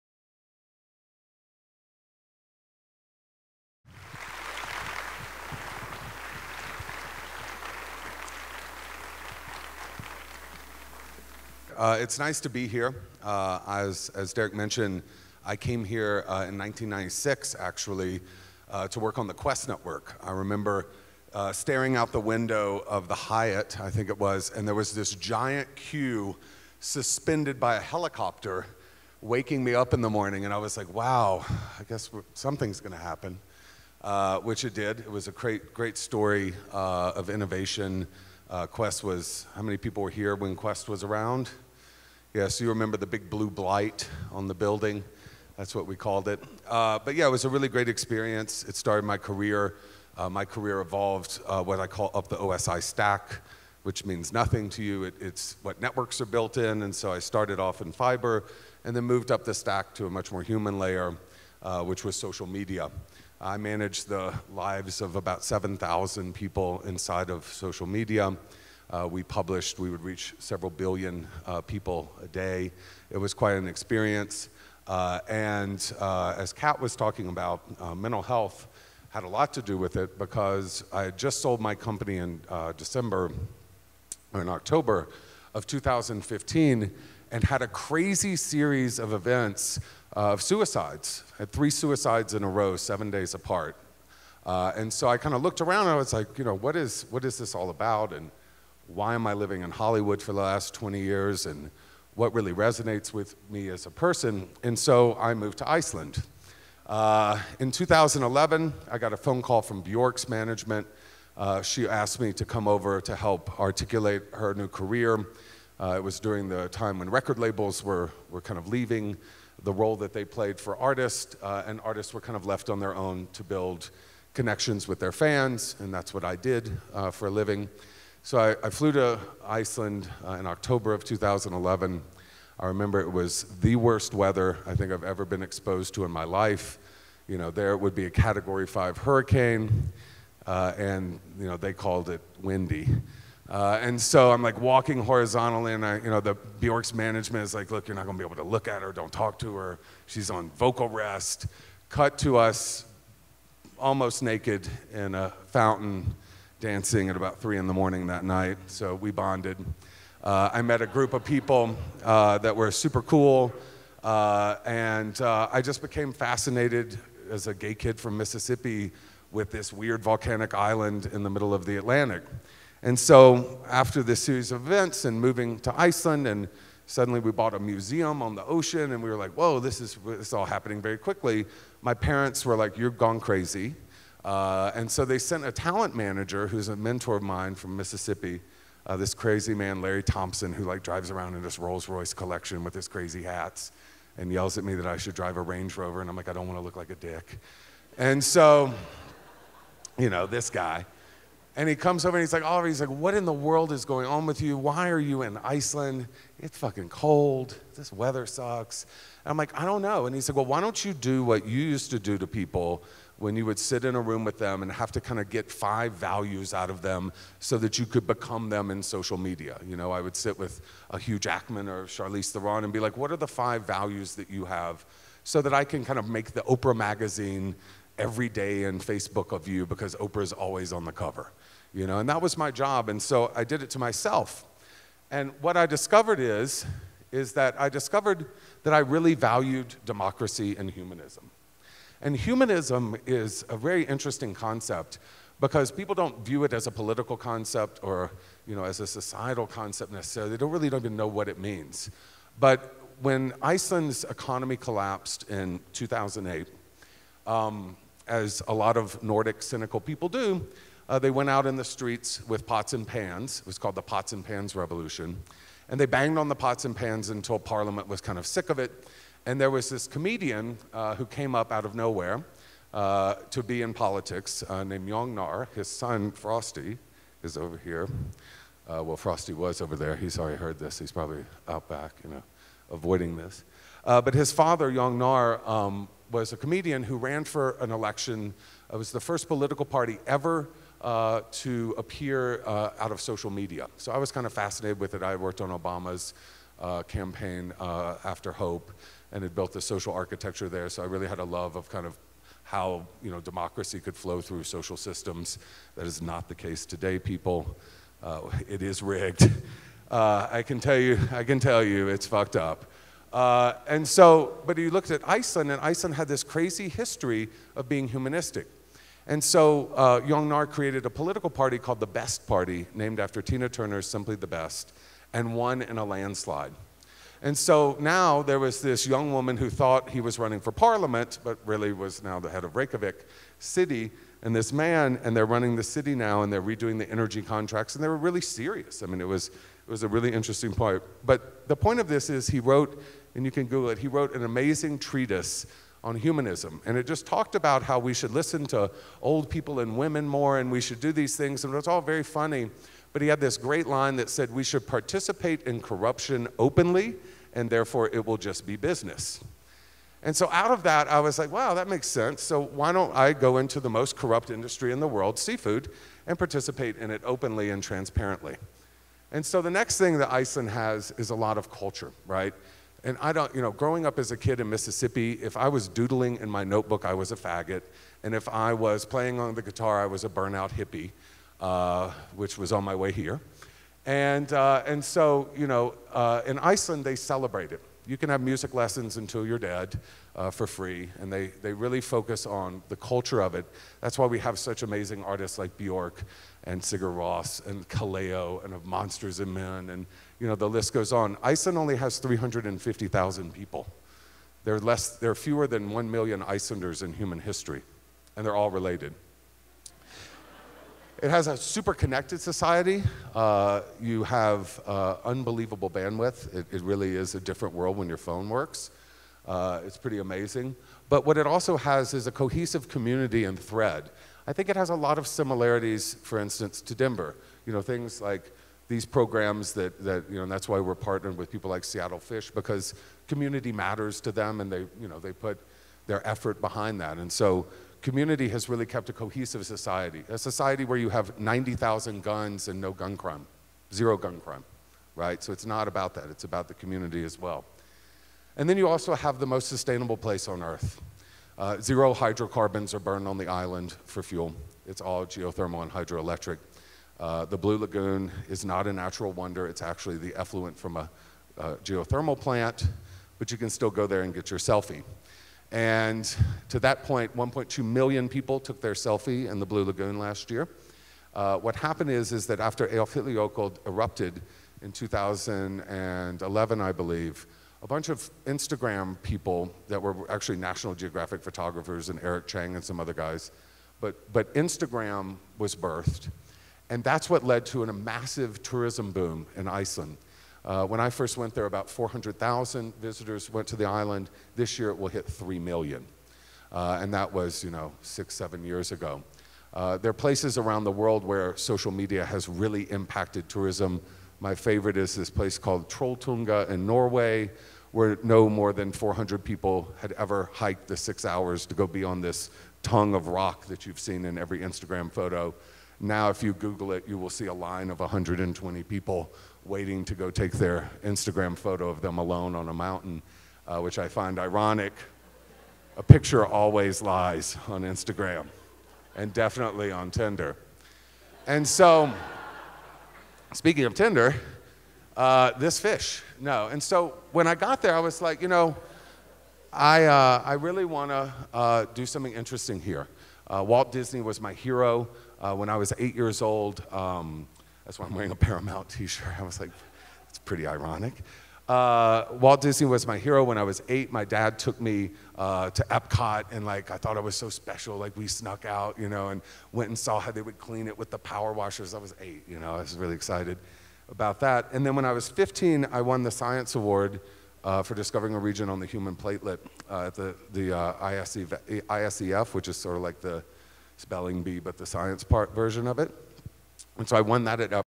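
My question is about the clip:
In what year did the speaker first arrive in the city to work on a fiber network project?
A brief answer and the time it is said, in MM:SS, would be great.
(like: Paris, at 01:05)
1996, at 00:16.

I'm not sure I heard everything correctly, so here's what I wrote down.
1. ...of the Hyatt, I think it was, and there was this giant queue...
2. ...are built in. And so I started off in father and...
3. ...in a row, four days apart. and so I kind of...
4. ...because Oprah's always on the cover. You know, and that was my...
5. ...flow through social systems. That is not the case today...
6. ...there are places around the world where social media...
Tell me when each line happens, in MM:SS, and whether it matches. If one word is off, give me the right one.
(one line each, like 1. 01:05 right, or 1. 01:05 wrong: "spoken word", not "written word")
1. 00:22 right
2. 00:56 wrong: "fiber", not "father"
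3. 01:32 wrong: "seven", not "four"
4. 03:49 right
5. 05:03 right
6. 08:19 right.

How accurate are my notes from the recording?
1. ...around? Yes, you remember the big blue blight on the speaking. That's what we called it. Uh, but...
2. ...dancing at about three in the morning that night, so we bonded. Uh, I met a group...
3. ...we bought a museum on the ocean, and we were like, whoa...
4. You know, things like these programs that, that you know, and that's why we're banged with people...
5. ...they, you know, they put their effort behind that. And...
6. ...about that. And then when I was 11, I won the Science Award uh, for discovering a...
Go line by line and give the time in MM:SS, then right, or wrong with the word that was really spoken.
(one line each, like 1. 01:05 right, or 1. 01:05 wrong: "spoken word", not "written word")
1. 00:41 wrong: "building", not "speaking"
2. 02:36 right
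3. 02:57 right
4. 07:07 wrong: "partnered", not "banged"
5. 07:14 right
6. 09:23 wrong: "15", not "11".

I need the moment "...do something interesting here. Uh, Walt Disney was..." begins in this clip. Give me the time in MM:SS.
09:01.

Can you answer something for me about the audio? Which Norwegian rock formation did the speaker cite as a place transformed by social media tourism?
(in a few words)
Trolltunga.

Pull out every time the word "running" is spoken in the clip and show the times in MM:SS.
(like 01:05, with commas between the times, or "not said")
05:30, 05:35.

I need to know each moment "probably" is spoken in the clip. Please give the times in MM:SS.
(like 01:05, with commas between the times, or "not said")
04:40.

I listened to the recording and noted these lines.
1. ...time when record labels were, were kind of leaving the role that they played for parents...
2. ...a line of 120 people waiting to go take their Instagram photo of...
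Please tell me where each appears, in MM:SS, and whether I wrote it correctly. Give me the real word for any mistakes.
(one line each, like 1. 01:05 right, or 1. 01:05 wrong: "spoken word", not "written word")
1. 01:56 wrong: "artists", not "parents"
2. 08:37 right.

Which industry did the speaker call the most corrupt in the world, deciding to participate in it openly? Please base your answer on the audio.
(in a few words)
Seafood.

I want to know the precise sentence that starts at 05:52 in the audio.
But he had this great line that said, We should participate in corruption openly, and therefore it will just be business.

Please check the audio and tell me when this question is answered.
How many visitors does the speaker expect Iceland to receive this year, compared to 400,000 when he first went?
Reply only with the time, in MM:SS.
08:15.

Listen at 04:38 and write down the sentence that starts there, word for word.
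Uh, well, Frosty was over there.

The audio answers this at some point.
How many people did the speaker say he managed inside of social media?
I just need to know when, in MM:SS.
01:05.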